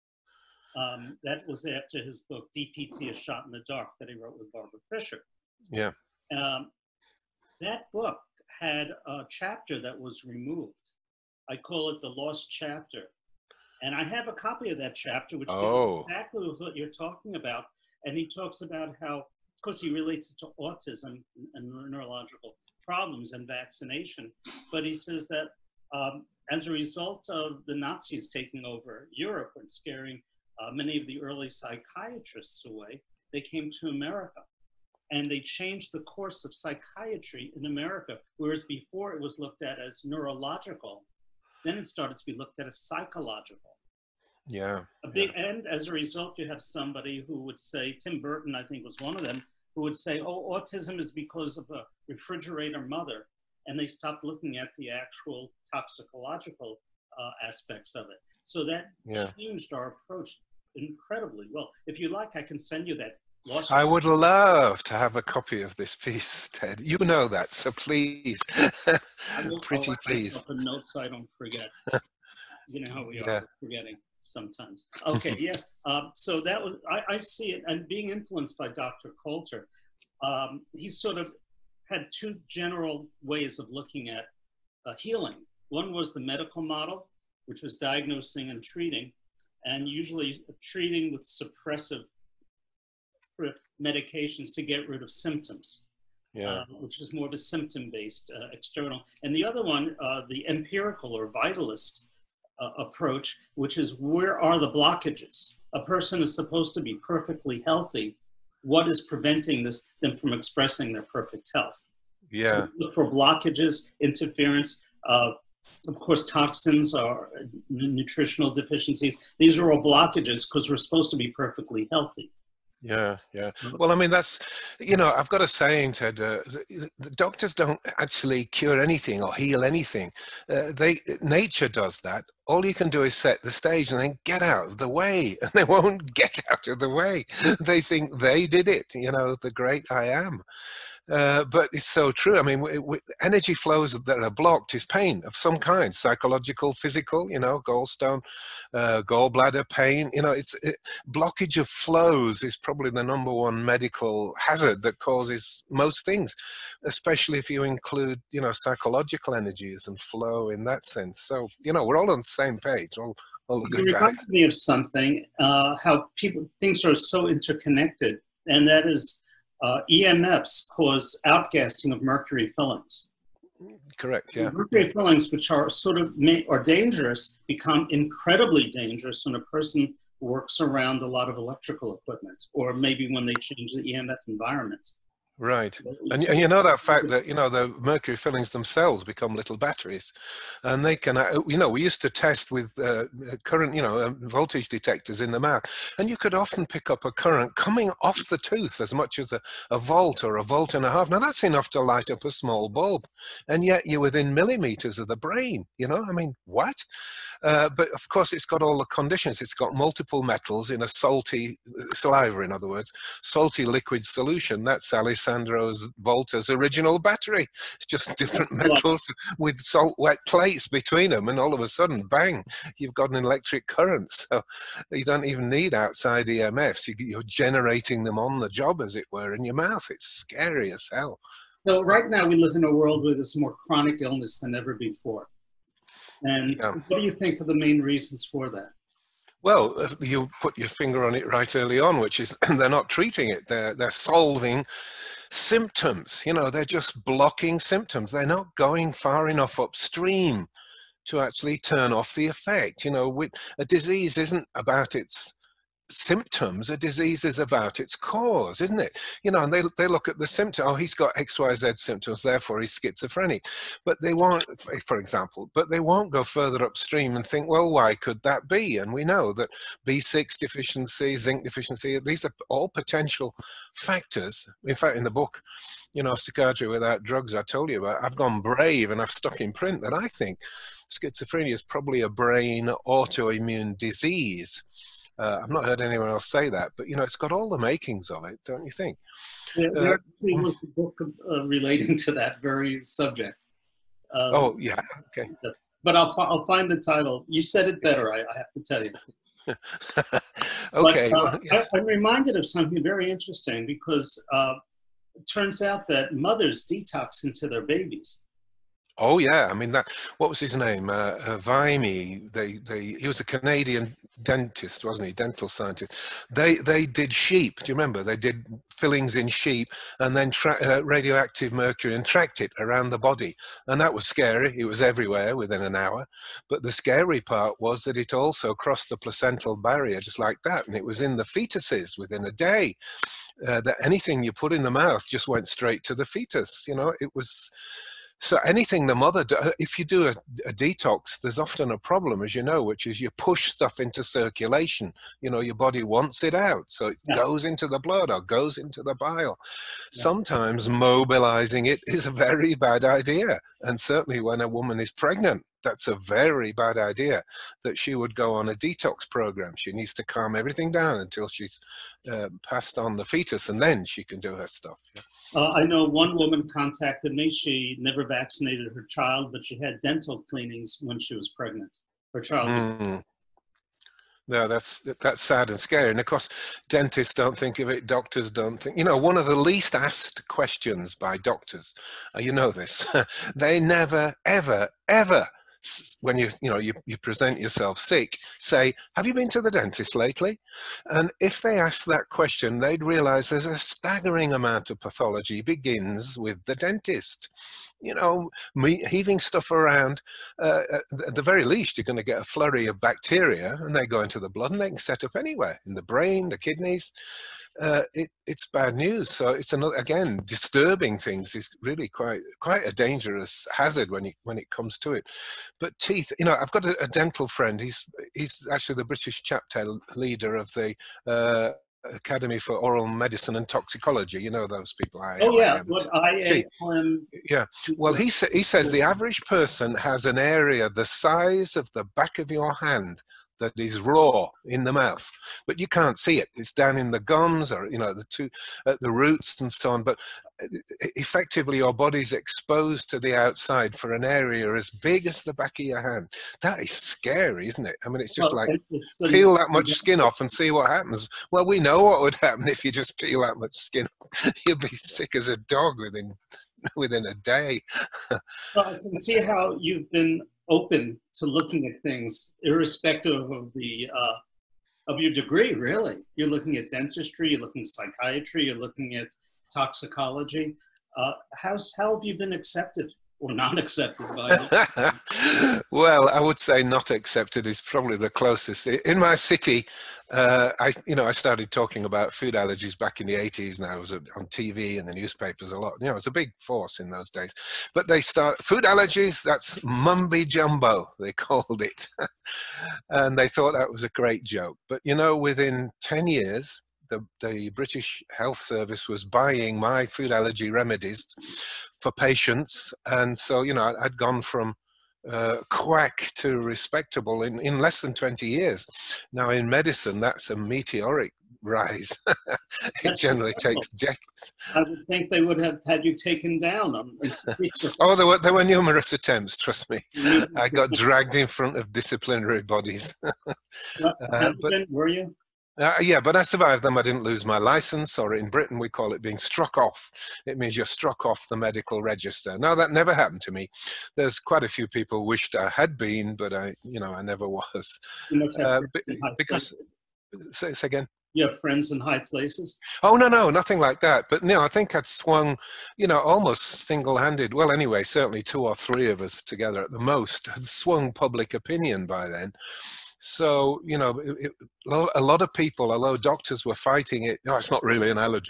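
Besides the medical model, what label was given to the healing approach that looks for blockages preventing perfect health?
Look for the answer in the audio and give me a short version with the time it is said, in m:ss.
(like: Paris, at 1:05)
empirical or vitalist, at 1:40.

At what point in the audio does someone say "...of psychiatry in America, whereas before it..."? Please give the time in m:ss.
0:36.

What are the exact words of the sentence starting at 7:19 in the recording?
But uh, effectively your body's exposed to the outside for an area as big as the back of your hand.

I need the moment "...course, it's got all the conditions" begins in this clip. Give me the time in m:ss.
3:28.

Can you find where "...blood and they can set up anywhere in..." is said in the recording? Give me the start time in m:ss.
6:44.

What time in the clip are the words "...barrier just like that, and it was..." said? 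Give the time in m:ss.
5:29.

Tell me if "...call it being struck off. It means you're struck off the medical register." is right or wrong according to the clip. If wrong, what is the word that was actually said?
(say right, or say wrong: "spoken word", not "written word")
right.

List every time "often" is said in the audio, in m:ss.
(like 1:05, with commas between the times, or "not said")
3:16, 5:41.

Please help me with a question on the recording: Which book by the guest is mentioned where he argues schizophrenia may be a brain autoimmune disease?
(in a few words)
Psychiatry Without Drugs.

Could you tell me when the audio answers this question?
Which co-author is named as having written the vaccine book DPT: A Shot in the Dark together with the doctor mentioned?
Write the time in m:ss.
0:04.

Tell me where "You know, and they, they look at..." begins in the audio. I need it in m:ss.
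4:19.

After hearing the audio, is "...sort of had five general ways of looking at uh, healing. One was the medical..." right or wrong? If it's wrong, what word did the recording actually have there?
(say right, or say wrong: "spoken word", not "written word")
wrong: "two", not "five".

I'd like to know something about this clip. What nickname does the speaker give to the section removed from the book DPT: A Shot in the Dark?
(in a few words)
The Lost Chapter.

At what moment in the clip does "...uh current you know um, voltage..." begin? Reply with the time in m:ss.
3:13.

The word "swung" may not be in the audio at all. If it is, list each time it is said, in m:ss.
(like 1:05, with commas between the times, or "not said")
9:04, 9:10.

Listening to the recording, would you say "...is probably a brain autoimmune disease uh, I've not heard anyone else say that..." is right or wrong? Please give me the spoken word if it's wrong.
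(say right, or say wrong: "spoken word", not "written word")
right.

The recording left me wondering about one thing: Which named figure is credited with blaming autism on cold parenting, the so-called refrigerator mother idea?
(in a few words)
Tim Burton.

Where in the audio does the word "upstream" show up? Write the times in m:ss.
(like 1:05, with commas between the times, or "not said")
4:09, 4:26.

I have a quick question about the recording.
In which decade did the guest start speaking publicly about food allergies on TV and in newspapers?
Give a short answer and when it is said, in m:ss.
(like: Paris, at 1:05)
the 80s, at 8:03.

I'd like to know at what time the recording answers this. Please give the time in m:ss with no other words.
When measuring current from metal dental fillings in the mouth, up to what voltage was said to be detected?
3:20.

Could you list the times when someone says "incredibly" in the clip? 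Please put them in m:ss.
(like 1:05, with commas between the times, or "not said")
1:00, 2:57.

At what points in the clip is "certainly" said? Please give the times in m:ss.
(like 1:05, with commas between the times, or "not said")
5:53, 9:07.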